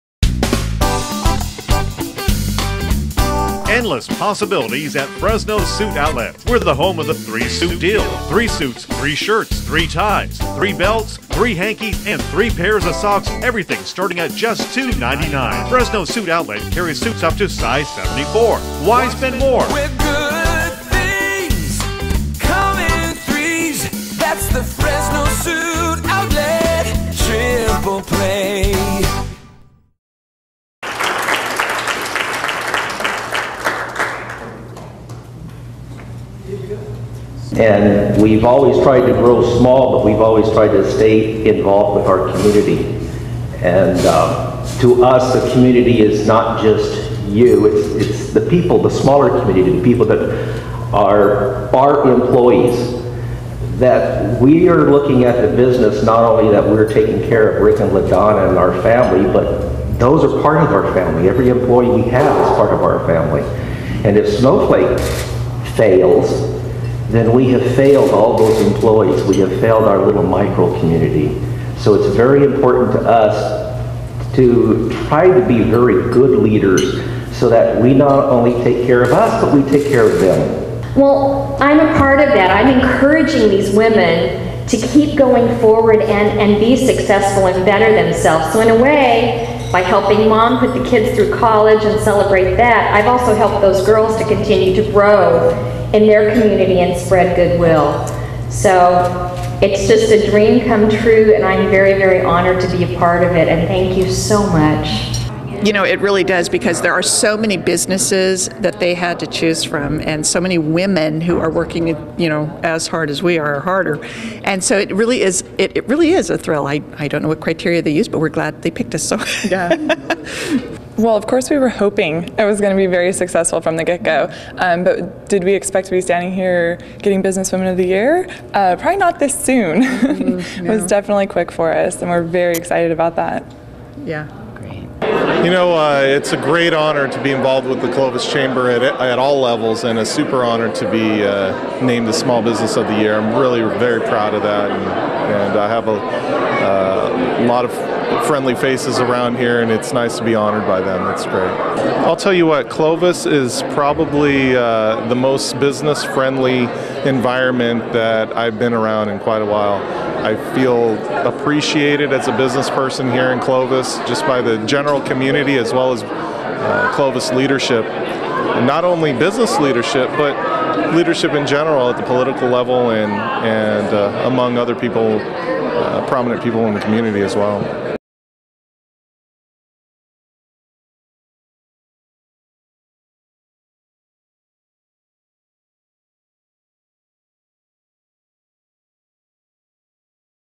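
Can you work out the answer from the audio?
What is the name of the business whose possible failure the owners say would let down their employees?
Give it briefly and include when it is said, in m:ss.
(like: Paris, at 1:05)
Snowflake, at 1:04.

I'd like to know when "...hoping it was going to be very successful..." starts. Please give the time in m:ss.
2:01.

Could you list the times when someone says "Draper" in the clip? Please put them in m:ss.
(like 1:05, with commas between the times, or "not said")
not said.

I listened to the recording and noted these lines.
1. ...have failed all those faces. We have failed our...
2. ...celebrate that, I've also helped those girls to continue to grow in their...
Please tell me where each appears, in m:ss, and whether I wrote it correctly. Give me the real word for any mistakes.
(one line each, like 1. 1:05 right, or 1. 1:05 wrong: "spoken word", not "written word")
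1. 1:07 wrong: "employees", not "faces"
2. 1:32 right.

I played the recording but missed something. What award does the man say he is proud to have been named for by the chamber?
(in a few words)
Small Business of the Year.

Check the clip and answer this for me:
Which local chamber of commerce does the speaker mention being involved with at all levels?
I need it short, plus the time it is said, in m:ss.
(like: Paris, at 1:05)
Clovis Chamber, at 2:17.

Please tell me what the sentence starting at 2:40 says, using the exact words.
I feel appreciated as a business person here in Clovis, just by the general community as well as uh, Clovis leadership.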